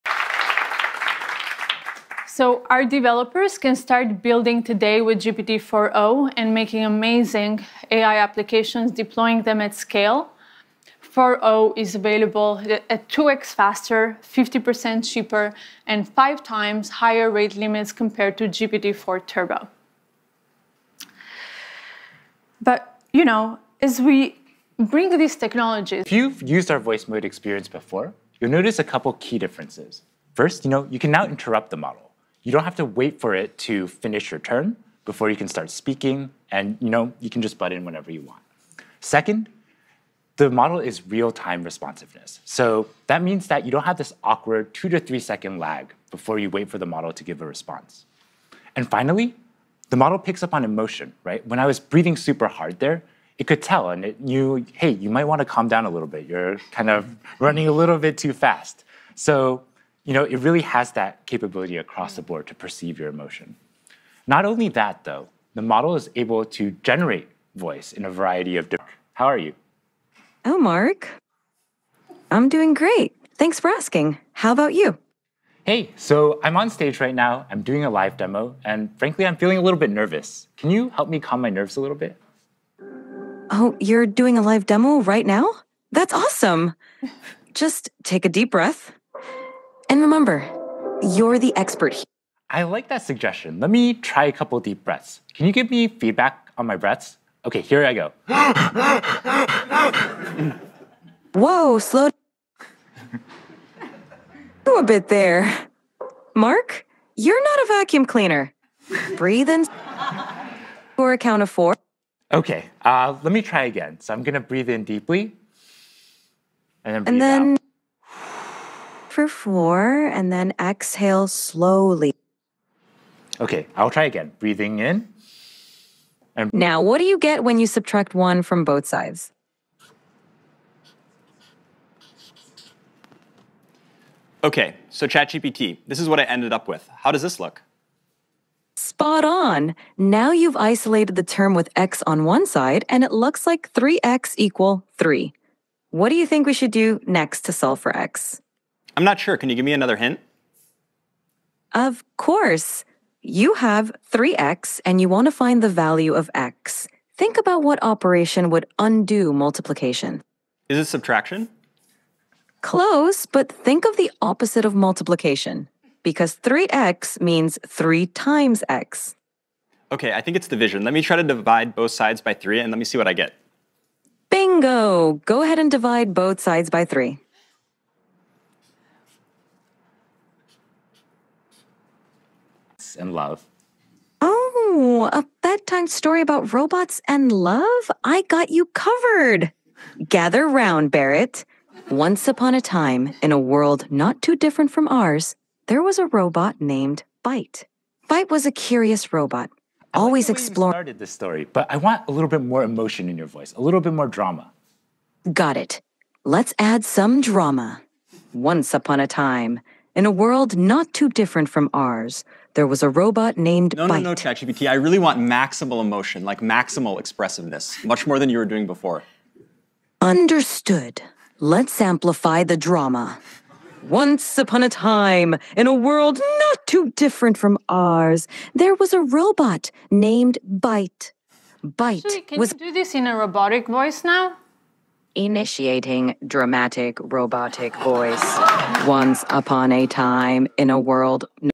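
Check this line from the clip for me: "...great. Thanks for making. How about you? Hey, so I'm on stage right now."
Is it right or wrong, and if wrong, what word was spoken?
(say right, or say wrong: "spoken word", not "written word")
wrong: "asking", not "making".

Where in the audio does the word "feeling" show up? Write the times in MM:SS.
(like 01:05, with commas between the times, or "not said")
01:19.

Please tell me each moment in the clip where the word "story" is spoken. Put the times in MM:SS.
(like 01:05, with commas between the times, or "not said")
03:05, 03:21.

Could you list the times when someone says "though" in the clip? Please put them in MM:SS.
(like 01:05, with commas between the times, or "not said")
01:05.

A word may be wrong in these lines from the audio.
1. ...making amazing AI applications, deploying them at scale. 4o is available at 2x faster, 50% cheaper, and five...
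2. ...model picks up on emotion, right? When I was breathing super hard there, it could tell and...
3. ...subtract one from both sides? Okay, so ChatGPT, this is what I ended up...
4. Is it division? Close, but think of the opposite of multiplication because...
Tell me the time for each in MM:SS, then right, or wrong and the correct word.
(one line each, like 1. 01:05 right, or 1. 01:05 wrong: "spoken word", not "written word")
1. 00:06 right
2. 00:49 right
3. 02:07 right
4. 02:40 wrong: "subtraction", not "division".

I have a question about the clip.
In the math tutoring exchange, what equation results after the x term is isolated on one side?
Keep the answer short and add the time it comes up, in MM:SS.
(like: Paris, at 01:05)
3x = 3, at 02:23.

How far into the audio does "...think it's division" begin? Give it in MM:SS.
02:50.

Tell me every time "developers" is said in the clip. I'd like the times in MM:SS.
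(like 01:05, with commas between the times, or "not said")
00:02.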